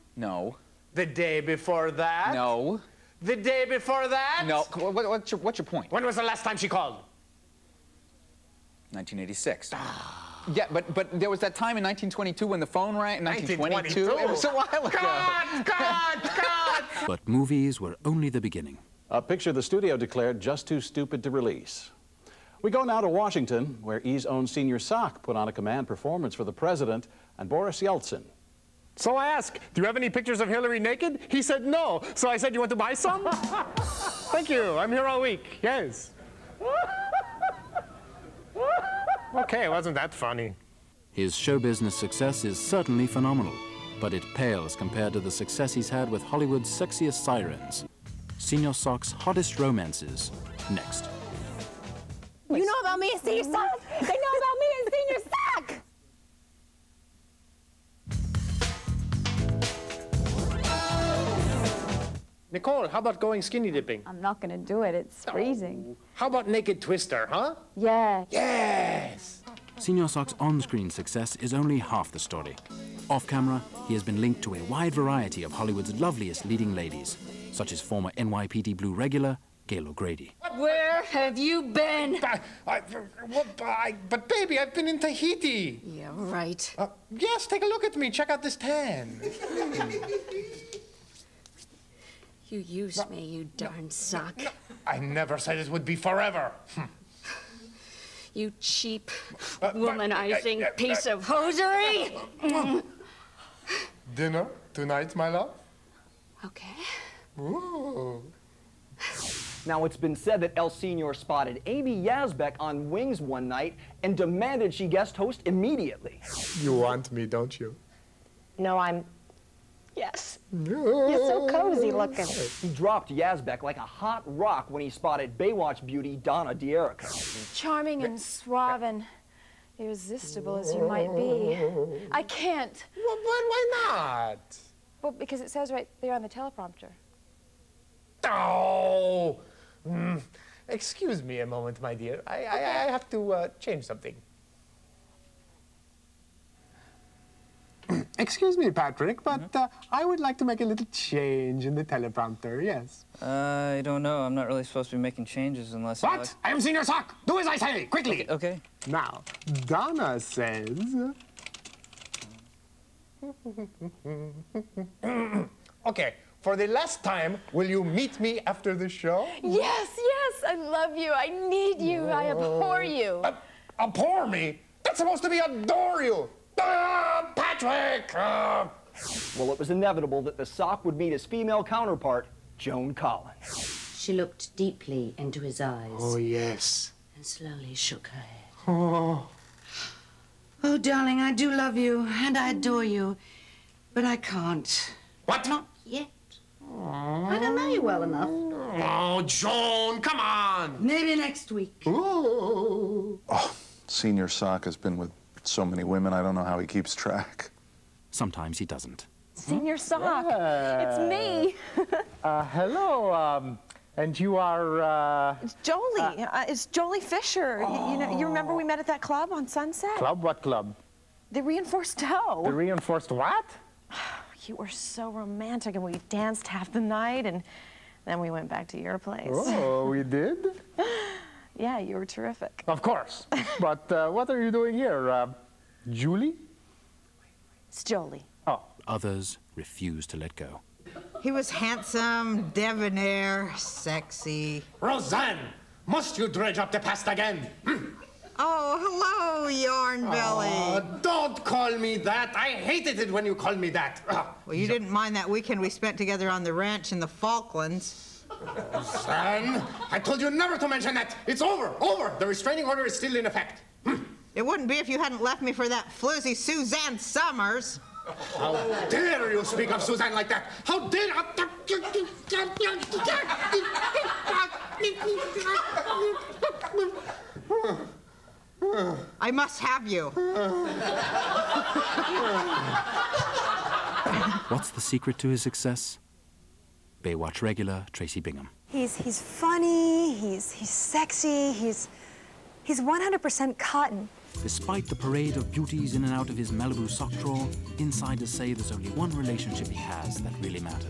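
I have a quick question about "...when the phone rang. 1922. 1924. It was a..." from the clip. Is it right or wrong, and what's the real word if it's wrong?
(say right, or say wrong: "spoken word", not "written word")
wrong: "1922", not "1924".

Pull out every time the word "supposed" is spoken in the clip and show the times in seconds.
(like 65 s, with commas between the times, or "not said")
154 s, 175 s.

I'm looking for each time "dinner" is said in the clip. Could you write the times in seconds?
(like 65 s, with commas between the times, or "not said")
104 s.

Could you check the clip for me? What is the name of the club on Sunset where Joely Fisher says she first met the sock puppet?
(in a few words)
The reinforced toe.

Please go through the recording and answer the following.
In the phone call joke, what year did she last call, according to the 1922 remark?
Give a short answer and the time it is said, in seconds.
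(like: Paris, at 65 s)
1986, at 8 s.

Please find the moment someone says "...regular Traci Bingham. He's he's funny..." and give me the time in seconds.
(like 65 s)
287 s.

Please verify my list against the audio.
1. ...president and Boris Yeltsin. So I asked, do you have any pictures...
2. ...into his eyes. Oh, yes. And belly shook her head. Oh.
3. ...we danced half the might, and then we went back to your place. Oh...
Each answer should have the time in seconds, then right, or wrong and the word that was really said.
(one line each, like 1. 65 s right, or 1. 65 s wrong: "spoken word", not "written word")
1. 26 s right
2. 185 s wrong: "slowly", not "belly"
3. 225 s wrong: "night", not "might".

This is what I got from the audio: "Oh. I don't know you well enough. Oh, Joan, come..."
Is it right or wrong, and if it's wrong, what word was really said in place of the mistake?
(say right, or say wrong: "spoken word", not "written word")
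right.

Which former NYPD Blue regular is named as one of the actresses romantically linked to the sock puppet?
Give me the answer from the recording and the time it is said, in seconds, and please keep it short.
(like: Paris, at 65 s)
Gail O'Grady, at 79 s.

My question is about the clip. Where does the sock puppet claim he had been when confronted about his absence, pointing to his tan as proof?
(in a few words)
Tahiti.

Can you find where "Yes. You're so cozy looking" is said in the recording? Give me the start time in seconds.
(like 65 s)
119 s.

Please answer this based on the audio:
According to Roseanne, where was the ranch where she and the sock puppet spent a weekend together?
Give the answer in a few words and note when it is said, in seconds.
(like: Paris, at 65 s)
the Falklands, at 256 s.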